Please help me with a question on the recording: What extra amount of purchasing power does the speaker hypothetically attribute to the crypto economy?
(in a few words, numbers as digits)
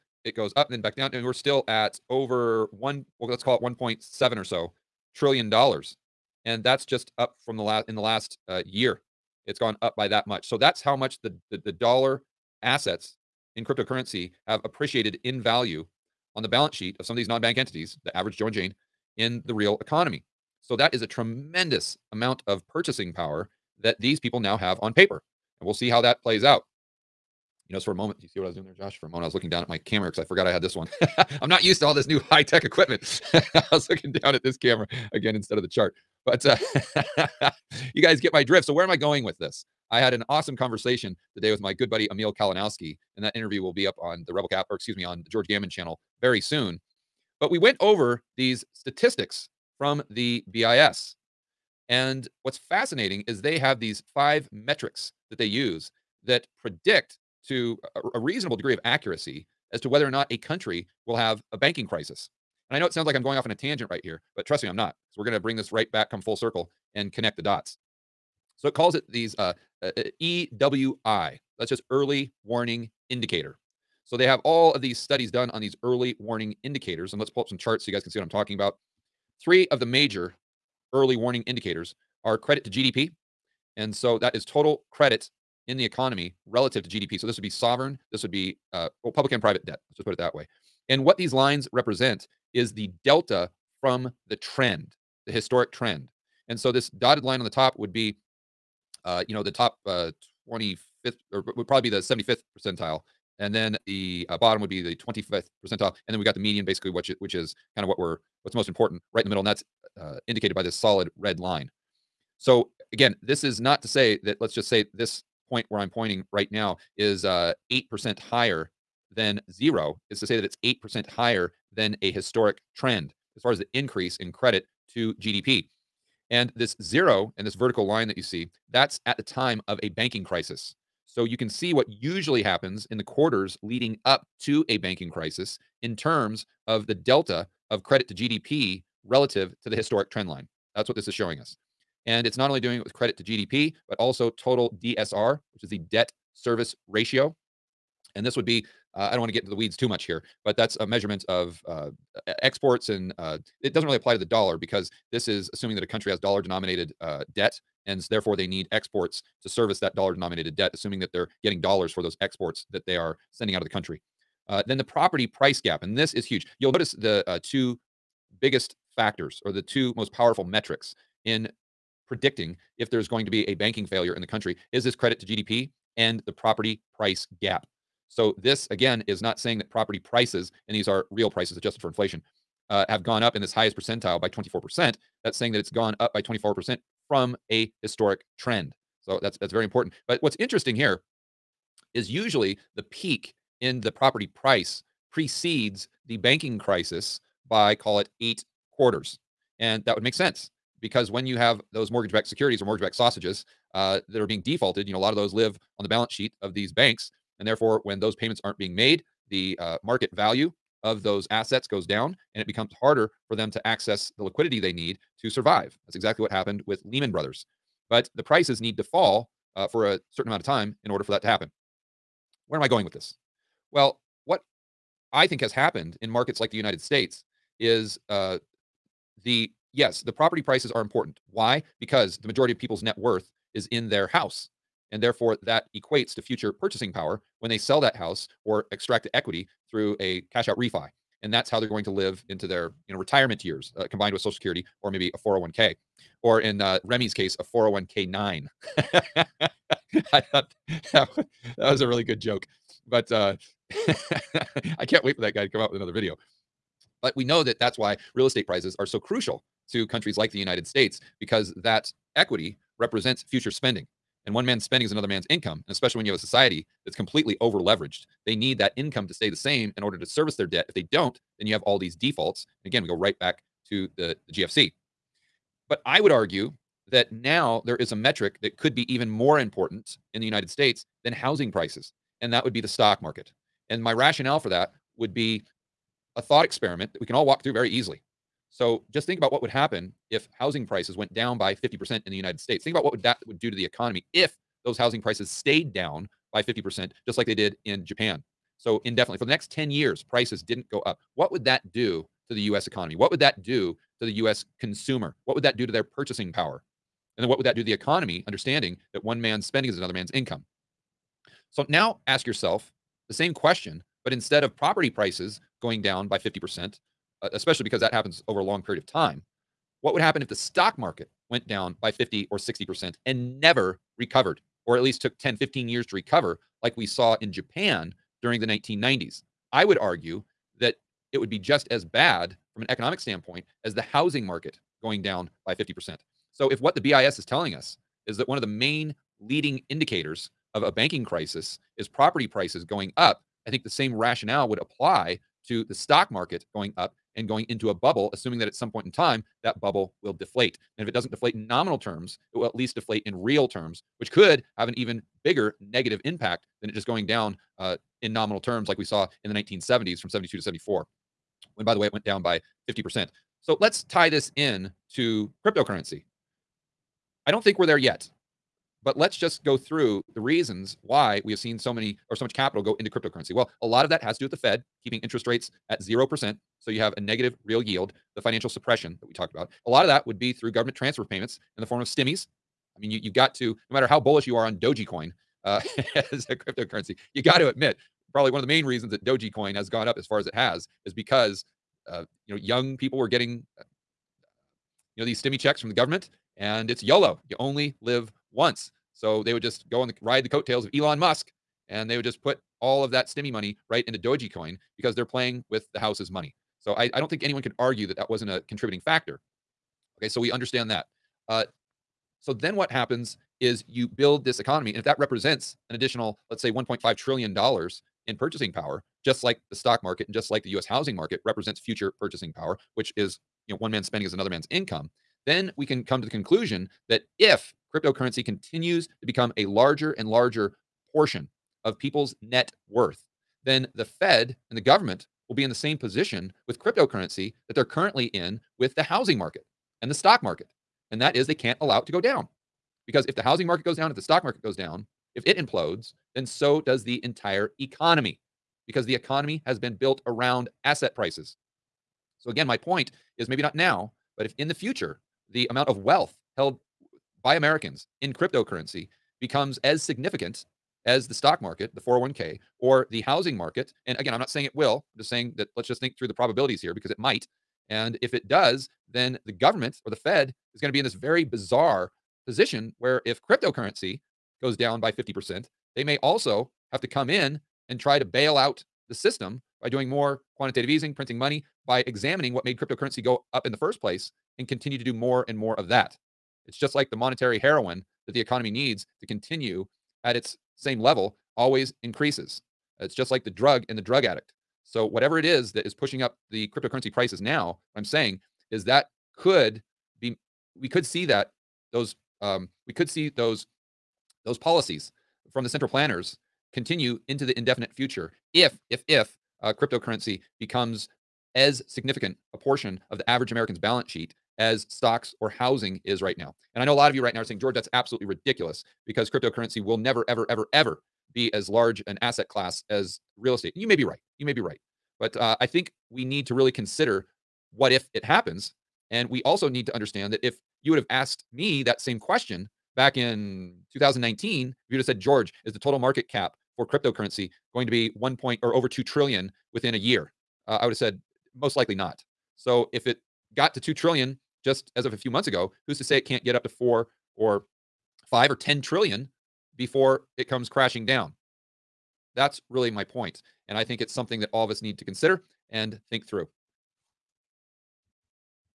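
$1.5 trillion.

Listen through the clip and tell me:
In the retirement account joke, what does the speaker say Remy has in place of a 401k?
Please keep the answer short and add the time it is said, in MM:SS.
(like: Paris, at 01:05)
401k nine, at 04:07.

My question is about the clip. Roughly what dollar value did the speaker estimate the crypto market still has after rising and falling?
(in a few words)
1.7 trillion dollars.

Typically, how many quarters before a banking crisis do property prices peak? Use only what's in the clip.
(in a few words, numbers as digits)
8.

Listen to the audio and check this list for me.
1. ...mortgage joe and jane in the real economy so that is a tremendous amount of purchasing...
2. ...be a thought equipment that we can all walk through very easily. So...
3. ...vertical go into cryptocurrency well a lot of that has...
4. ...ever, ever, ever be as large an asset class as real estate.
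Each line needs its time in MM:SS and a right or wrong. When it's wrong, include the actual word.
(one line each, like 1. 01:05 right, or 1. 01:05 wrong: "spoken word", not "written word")
1. 00:18 wrong: "average", not "mortgage"
2. 04:45 wrong: "experiment", not "equipment"
3. 06:12 wrong: "capital", not "vertical"
4. 08:40 right.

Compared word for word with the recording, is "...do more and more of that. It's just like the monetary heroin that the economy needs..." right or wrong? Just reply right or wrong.
right.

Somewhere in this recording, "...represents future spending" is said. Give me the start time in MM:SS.
04:22.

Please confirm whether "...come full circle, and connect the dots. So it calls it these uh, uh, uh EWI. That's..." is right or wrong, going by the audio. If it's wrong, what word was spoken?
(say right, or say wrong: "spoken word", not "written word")
right.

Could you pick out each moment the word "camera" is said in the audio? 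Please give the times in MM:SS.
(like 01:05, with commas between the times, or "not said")
00:29, 00:34.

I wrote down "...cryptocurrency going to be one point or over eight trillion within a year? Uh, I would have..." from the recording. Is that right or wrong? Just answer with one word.
wrong.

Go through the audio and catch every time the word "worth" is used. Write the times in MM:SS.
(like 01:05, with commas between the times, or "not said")
03:52, 07:12.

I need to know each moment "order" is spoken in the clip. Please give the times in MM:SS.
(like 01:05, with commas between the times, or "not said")
03:40, 04:29.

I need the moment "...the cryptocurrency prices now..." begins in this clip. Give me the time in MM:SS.
08:16.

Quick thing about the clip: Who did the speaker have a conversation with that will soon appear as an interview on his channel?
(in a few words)
Emil Kalinowski.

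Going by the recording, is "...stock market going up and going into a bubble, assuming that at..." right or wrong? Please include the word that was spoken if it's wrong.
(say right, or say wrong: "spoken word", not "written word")
right.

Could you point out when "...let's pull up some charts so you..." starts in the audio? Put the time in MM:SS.
01:17.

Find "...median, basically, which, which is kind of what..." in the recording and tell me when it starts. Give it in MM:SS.
01:46.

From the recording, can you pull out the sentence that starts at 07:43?
And again, I'm not saying it will, I'm just saying that let's just think through the probabilities here because it might.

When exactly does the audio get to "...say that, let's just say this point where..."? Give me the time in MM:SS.
01:53.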